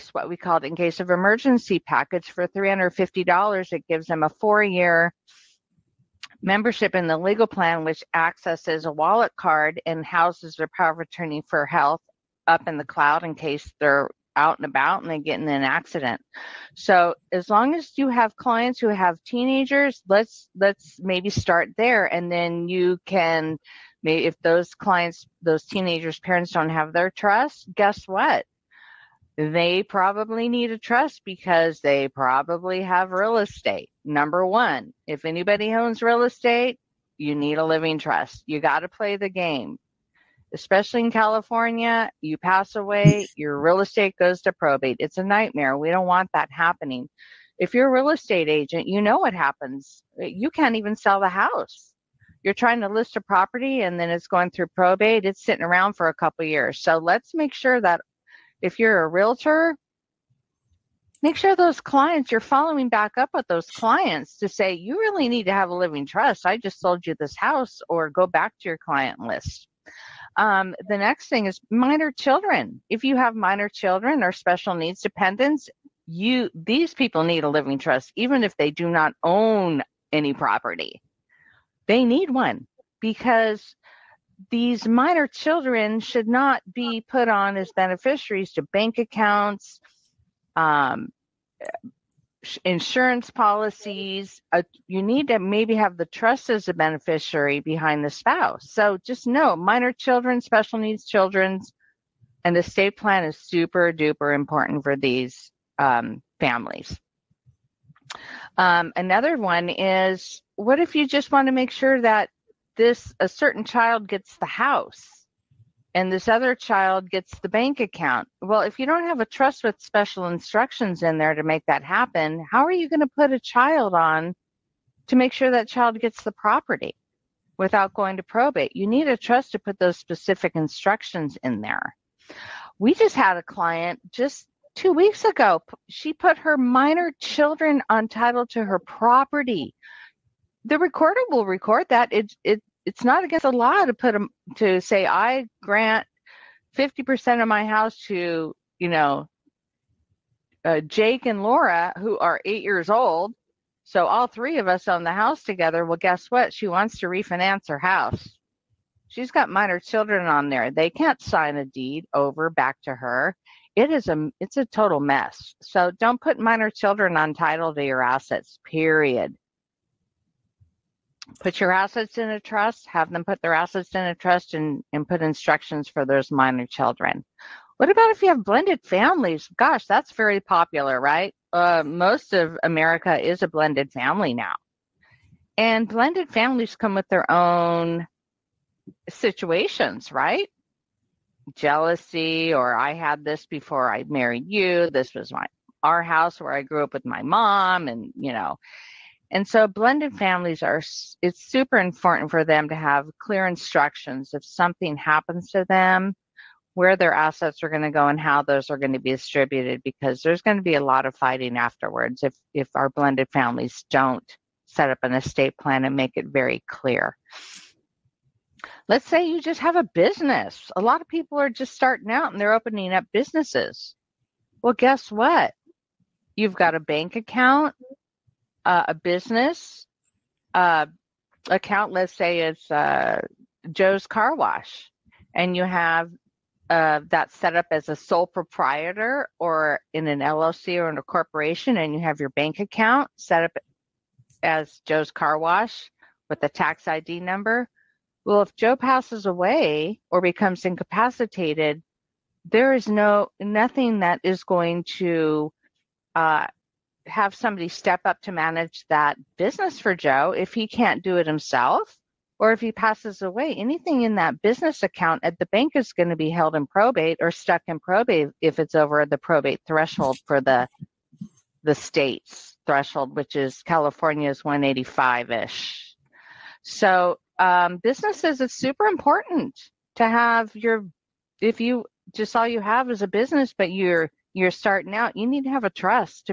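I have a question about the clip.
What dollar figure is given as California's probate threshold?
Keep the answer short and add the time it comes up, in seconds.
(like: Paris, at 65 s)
185, at 274 s.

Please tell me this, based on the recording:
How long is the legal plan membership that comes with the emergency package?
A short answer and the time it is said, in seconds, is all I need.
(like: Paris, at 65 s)
four year, at 4 s.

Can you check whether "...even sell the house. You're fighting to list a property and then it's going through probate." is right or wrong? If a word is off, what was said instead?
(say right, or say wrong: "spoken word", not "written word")
wrong: "trying", not "fighting".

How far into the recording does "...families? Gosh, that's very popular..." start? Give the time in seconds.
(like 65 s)
178 s.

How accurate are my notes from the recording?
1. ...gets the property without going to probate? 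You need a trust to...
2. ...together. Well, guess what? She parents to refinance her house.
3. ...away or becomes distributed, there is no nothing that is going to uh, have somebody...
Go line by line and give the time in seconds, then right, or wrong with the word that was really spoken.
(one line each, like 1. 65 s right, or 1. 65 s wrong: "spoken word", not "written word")
1. 125 s right
2. 155 s wrong: "wants", not "parents"
3. 249 s wrong: "incapacitated", not "distributed".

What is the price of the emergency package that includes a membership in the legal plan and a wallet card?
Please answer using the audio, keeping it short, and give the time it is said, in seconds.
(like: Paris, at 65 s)
$350, at 2 s.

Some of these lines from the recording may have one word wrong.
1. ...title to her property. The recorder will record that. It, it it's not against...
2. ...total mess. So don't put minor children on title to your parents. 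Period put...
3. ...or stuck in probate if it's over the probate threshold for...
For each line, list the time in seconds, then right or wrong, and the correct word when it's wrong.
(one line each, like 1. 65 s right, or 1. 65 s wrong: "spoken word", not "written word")
1. 138 s right
2. 164 s wrong: "assets", not "parents"
3. 267 s right.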